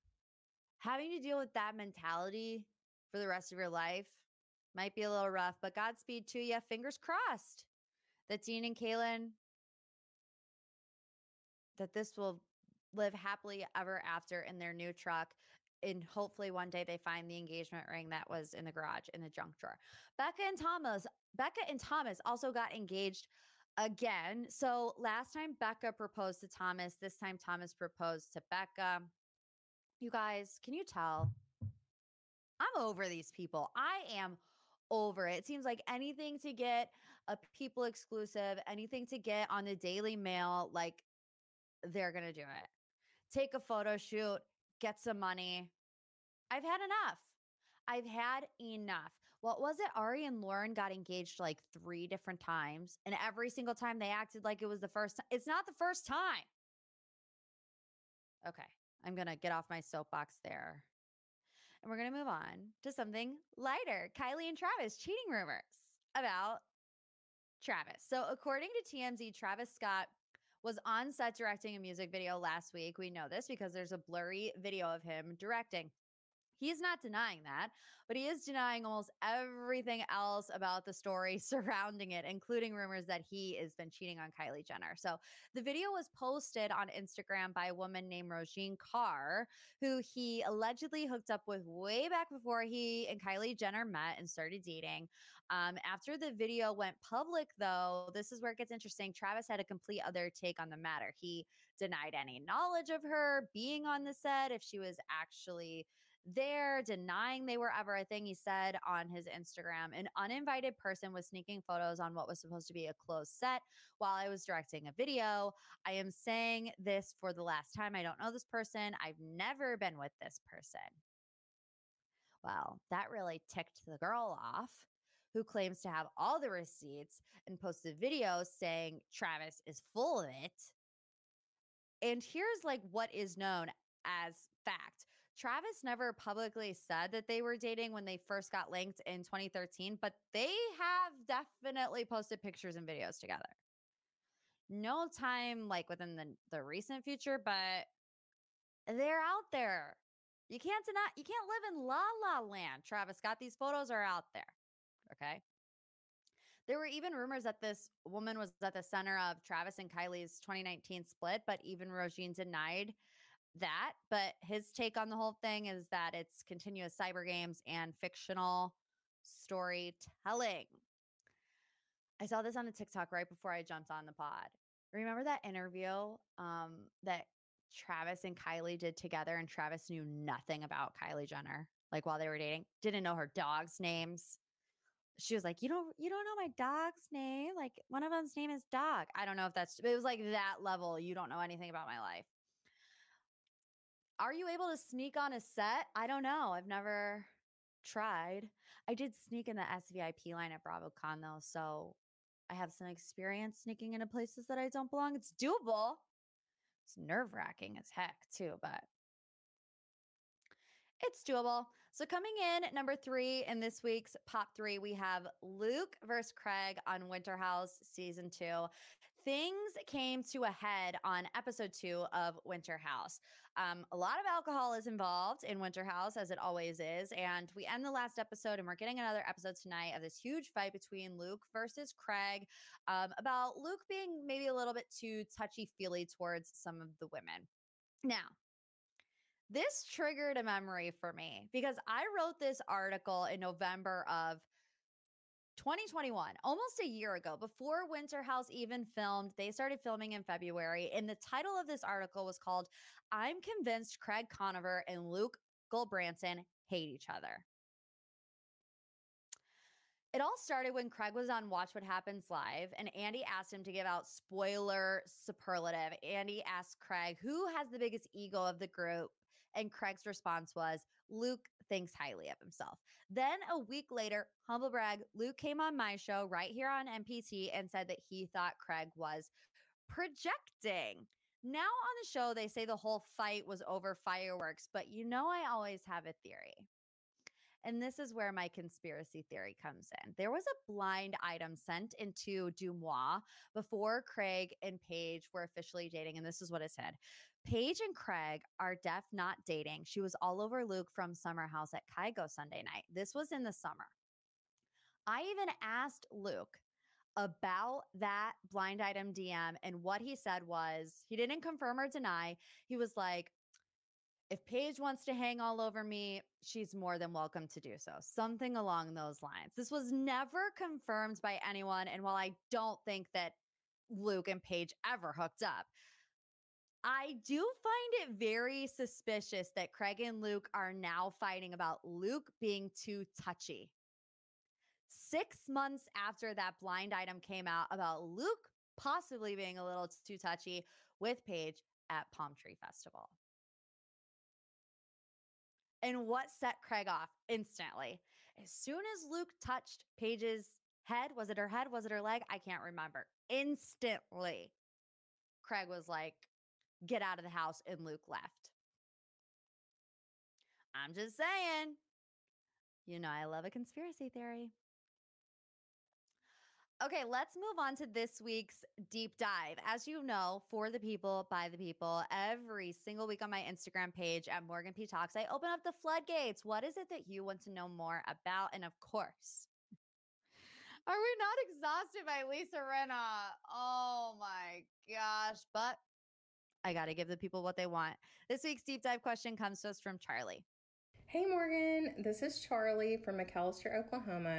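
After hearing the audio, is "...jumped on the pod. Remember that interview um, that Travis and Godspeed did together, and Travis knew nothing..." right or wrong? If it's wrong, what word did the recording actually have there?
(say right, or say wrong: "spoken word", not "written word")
wrong: "Kylie", not "Godspeed".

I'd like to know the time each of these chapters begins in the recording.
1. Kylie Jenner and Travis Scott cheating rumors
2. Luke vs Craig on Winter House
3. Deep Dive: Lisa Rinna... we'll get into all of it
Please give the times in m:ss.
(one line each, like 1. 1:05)
1. 0:54
2. 3:23
3. 5:56.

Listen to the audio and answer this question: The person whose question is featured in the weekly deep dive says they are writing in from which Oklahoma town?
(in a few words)
McAllister.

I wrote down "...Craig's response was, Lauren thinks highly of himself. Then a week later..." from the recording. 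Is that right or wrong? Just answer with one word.
wrong.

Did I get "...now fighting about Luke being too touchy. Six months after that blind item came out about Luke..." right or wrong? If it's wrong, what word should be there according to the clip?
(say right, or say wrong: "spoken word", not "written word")
right.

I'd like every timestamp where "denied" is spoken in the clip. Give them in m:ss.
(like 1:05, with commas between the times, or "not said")
1:41, 2:42.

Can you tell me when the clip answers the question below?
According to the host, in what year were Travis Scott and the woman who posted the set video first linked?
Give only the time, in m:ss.
2:19.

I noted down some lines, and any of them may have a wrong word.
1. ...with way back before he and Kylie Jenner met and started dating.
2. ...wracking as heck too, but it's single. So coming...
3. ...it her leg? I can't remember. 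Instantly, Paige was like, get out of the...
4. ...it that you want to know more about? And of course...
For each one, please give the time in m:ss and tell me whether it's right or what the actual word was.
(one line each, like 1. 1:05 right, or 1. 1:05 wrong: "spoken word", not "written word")
1. 1:31 right
2. 3:27 wrong: "doable", not "single"
3. 5:51 wrong: "Craig", not "Paige"
4. 6:16 right.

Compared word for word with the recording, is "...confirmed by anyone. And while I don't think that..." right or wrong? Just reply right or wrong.
right.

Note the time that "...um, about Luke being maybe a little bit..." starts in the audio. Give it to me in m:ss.
3:52.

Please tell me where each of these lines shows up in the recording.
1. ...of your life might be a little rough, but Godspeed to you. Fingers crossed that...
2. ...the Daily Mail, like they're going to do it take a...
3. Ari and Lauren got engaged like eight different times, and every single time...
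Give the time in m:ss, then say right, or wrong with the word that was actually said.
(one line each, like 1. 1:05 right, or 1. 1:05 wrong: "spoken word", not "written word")
1. 0:03 right
2. 0:39 right
3. 0:49 wrong: "three", not "eight".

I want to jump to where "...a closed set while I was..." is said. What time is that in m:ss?
1:52.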